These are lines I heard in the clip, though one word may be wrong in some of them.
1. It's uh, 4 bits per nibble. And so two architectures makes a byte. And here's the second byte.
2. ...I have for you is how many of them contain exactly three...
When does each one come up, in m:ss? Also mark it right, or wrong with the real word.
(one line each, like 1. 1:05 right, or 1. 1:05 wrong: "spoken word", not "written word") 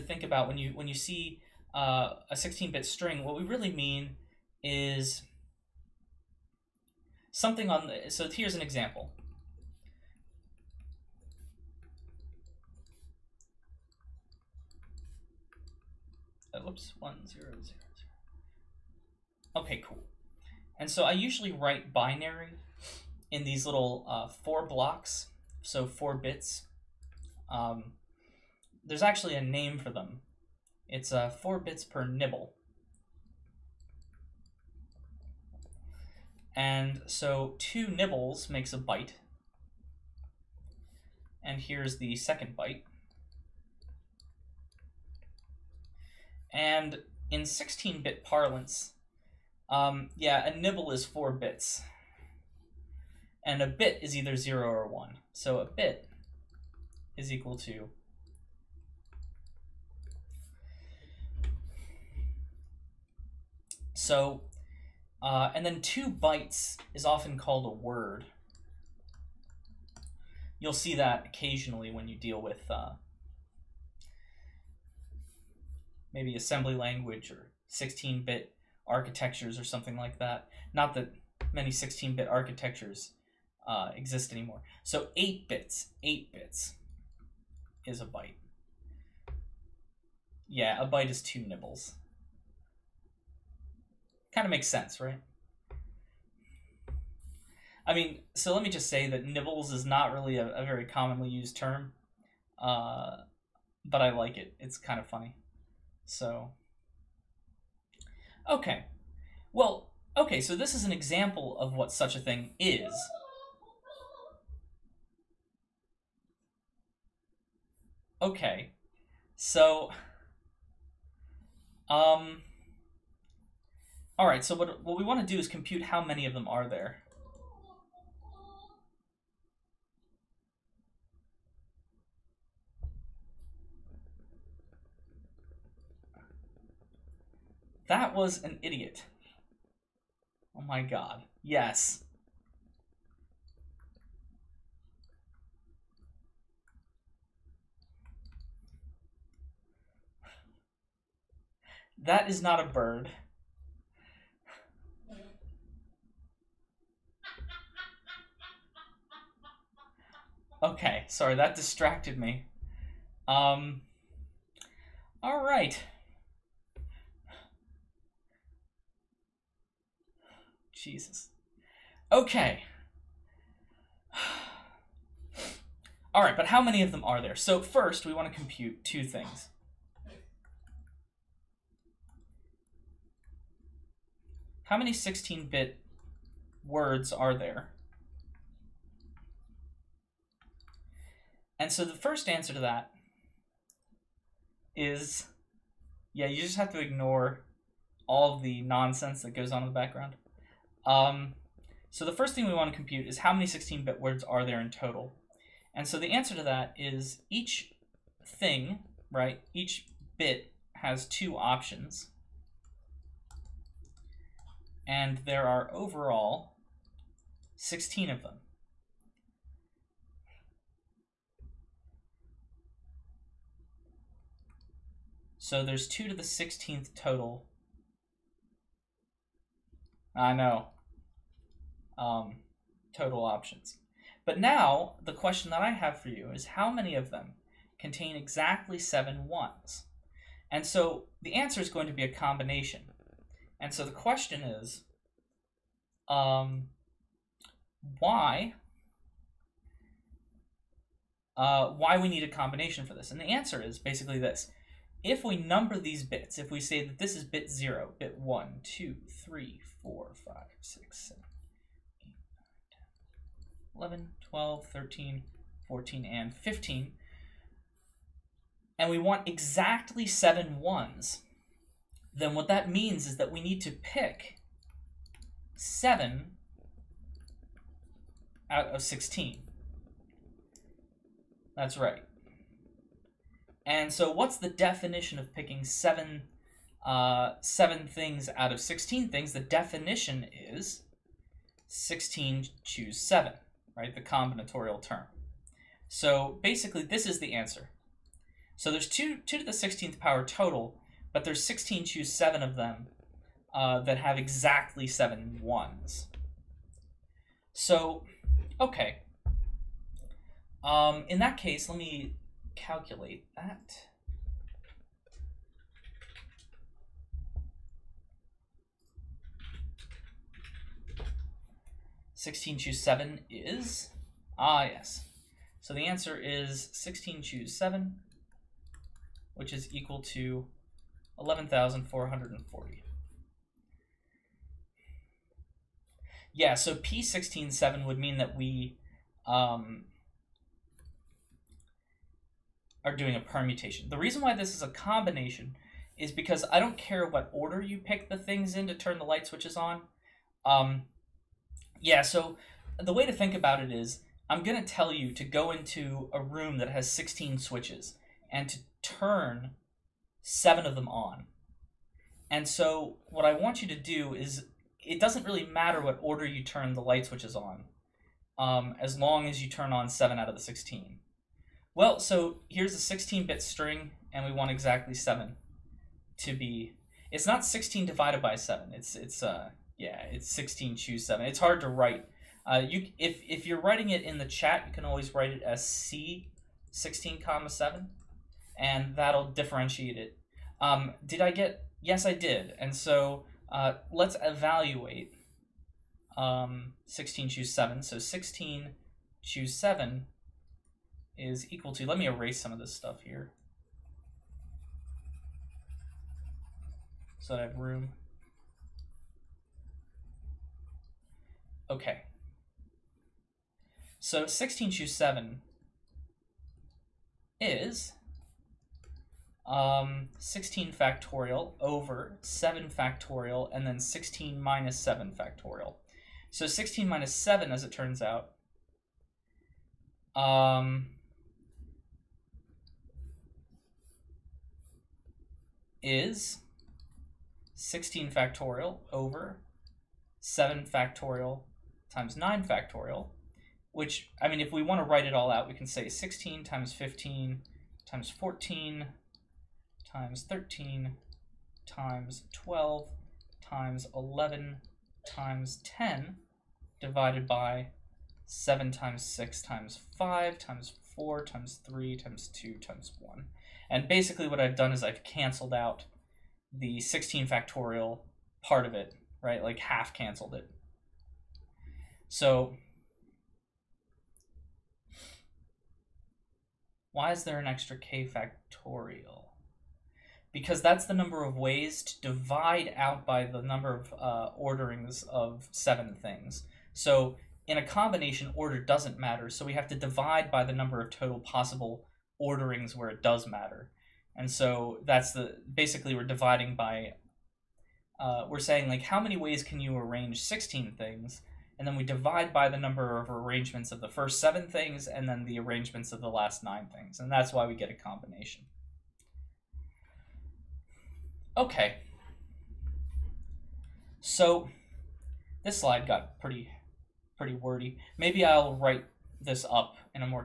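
1. 0:30 wrong: "nibbles", not "architectures"
2. 3:55 wrong: "seven", not "three".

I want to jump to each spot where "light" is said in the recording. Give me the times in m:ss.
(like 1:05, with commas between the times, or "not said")
5:49, 6:06.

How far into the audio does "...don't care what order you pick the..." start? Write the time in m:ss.
5:46.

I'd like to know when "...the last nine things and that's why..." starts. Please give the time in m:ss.
8:26.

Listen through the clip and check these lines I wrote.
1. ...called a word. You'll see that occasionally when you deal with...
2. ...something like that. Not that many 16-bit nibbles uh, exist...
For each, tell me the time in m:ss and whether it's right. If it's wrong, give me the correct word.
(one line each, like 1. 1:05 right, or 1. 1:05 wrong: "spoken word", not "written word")
1. 1:07 right
2. 1:19 wrong: "architectures", not "nibbles".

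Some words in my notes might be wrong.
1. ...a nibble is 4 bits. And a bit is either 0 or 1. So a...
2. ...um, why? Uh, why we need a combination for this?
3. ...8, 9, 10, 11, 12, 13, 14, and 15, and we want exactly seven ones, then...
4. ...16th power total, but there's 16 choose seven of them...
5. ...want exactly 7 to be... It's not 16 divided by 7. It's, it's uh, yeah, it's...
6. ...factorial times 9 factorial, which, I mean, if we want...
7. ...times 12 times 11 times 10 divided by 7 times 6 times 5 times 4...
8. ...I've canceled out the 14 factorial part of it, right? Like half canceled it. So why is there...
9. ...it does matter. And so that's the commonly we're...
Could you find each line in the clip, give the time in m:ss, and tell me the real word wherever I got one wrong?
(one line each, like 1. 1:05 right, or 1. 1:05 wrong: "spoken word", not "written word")
1. 0:50 right
2. 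4:06 right
3. 4:22 right
4. 4:59 right
5. 6:14 right
6. 7:20 right
7. 7:31 right
8. 7:44 wrong: "16", not "14"
9. 8:12 wrong: "basically", not "commonly".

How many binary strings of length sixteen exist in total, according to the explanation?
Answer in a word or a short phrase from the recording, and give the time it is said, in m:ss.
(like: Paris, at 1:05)
2 to the 16th, at 3:45.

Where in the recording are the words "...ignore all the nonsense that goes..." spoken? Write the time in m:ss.
3:16.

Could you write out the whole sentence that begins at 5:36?
Yeah, so P167 would mean that we um, are doing a permutation.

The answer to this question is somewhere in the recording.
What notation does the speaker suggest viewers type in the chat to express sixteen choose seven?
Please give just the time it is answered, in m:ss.
6:25.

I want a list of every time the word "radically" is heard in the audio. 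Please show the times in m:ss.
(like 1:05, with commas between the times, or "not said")
not said.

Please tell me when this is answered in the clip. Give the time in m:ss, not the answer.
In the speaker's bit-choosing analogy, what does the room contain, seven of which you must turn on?
5:56.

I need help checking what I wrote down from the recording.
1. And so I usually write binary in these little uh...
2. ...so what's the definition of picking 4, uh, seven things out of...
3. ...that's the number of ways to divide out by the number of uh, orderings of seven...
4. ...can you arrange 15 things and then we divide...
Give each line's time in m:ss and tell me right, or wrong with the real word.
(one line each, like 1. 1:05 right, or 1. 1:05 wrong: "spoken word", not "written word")
1. 0:20 right
2. 4:43 wrong: "7", not "4"
3. 8:00 right
4. 8:19 wrong: "16", not "15".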